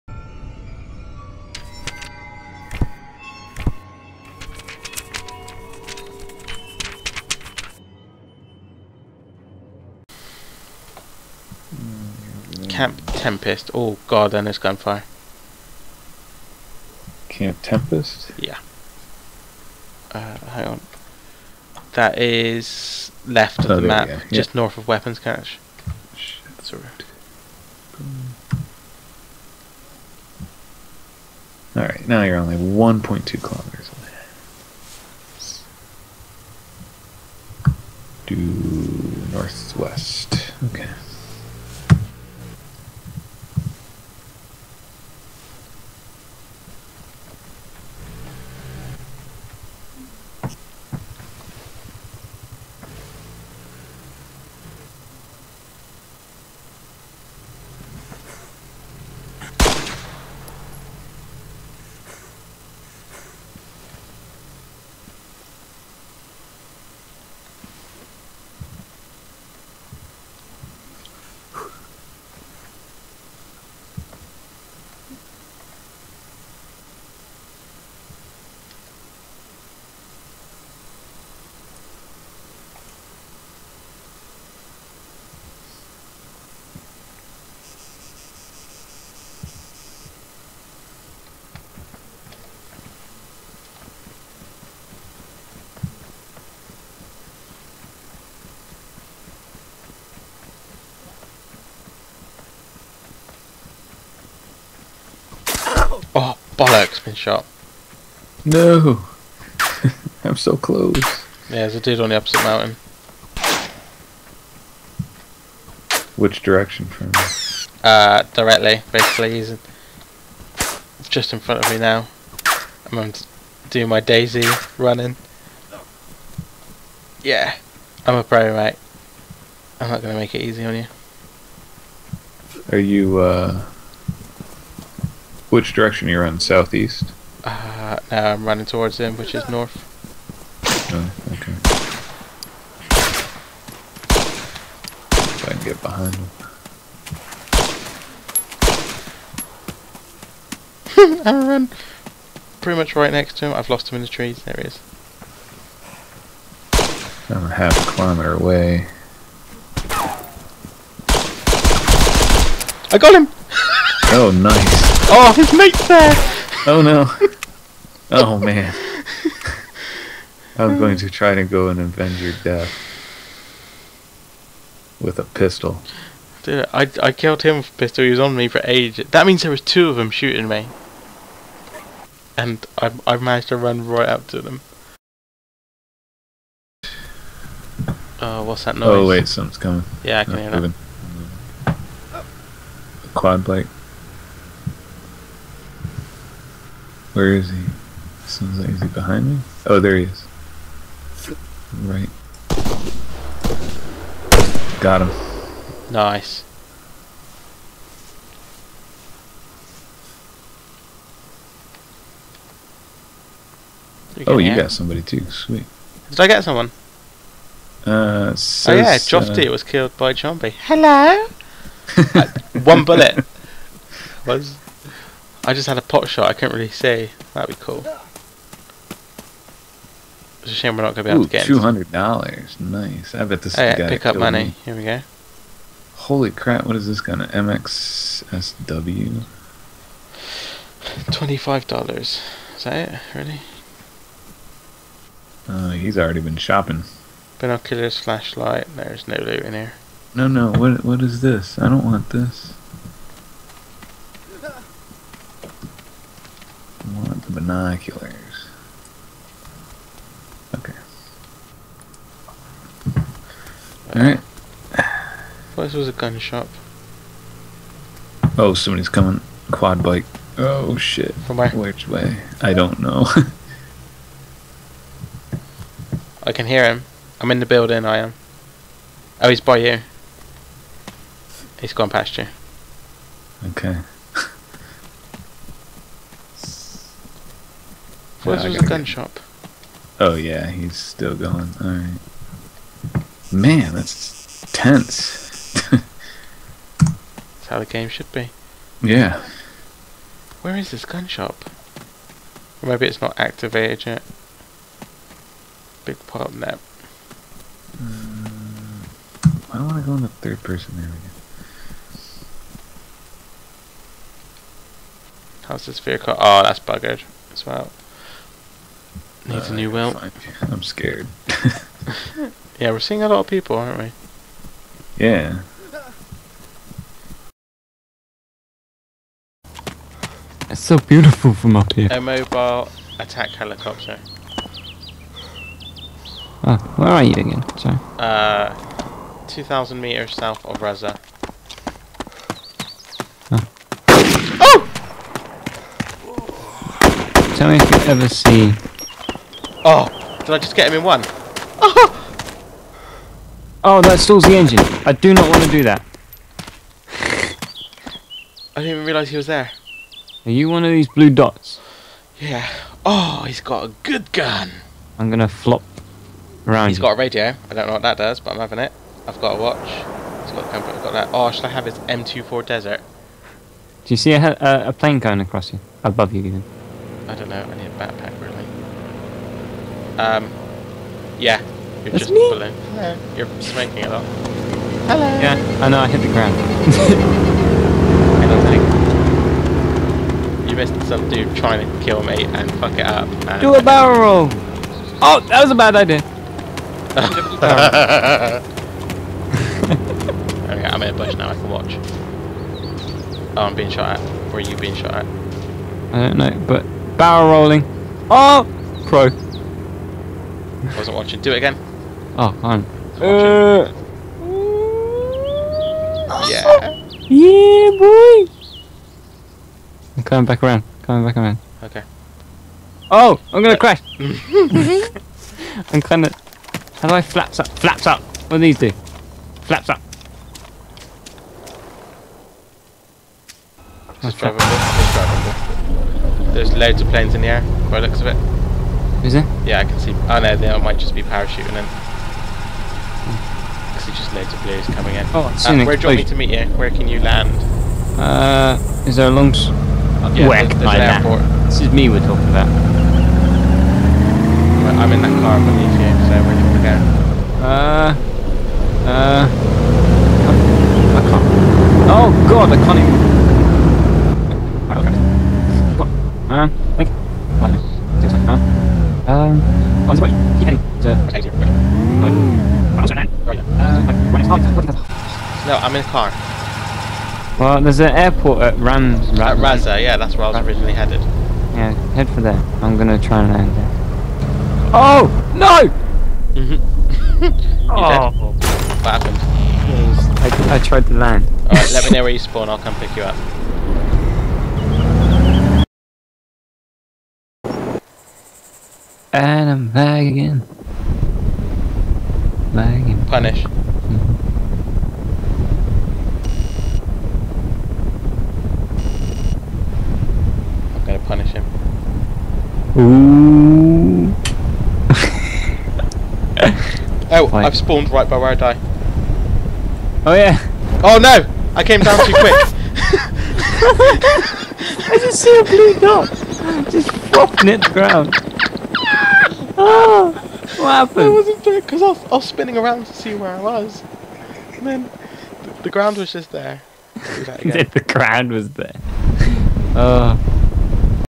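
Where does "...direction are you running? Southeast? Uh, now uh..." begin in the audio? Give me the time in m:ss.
2:15.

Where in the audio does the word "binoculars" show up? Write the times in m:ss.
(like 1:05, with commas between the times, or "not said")
4:07, 4:17.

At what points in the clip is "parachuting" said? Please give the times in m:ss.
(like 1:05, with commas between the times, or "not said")
7:21.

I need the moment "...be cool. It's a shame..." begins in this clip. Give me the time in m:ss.
3:47.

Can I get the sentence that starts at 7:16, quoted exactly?
There's loads of planes in the air.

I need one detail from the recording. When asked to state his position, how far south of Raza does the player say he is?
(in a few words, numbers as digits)
2,000 meters.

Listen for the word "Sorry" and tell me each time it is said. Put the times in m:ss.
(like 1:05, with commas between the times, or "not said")
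0:26, 5:37.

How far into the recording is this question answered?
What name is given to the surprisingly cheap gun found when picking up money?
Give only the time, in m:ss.
3:57.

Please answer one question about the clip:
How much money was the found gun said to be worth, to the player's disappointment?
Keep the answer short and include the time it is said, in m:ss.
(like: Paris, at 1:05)
$25, at 4:01.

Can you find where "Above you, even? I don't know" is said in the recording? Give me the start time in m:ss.
6:15.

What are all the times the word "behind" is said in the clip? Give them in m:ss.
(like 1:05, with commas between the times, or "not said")
2:25, 3:18.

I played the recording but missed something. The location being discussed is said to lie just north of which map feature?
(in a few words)
Weapons Cache.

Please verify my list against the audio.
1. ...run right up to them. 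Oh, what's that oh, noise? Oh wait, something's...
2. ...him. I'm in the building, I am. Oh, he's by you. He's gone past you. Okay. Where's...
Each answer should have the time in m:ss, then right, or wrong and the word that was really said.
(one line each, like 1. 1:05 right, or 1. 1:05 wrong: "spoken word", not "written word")
1. 3:03 right
2. 4:36 right.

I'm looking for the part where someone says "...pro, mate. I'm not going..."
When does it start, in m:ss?
2:08.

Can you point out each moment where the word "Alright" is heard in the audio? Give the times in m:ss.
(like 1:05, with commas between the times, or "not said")
0:31, 4:23, 4:51, 8:11.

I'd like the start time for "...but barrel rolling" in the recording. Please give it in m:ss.
6:46.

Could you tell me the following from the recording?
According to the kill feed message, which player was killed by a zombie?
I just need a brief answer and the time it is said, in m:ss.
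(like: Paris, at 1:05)
Jofty, at 3:38.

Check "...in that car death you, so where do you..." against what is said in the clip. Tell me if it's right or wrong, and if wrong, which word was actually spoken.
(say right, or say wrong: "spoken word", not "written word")
wrong: "beneath", not "death".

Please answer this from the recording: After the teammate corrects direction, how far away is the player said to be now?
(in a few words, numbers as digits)
1.2 kilometers.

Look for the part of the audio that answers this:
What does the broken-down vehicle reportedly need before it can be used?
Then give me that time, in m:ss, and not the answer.
5:19.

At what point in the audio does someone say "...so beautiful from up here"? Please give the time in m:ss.
5:30.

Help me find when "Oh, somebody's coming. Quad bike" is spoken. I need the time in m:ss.
4:28.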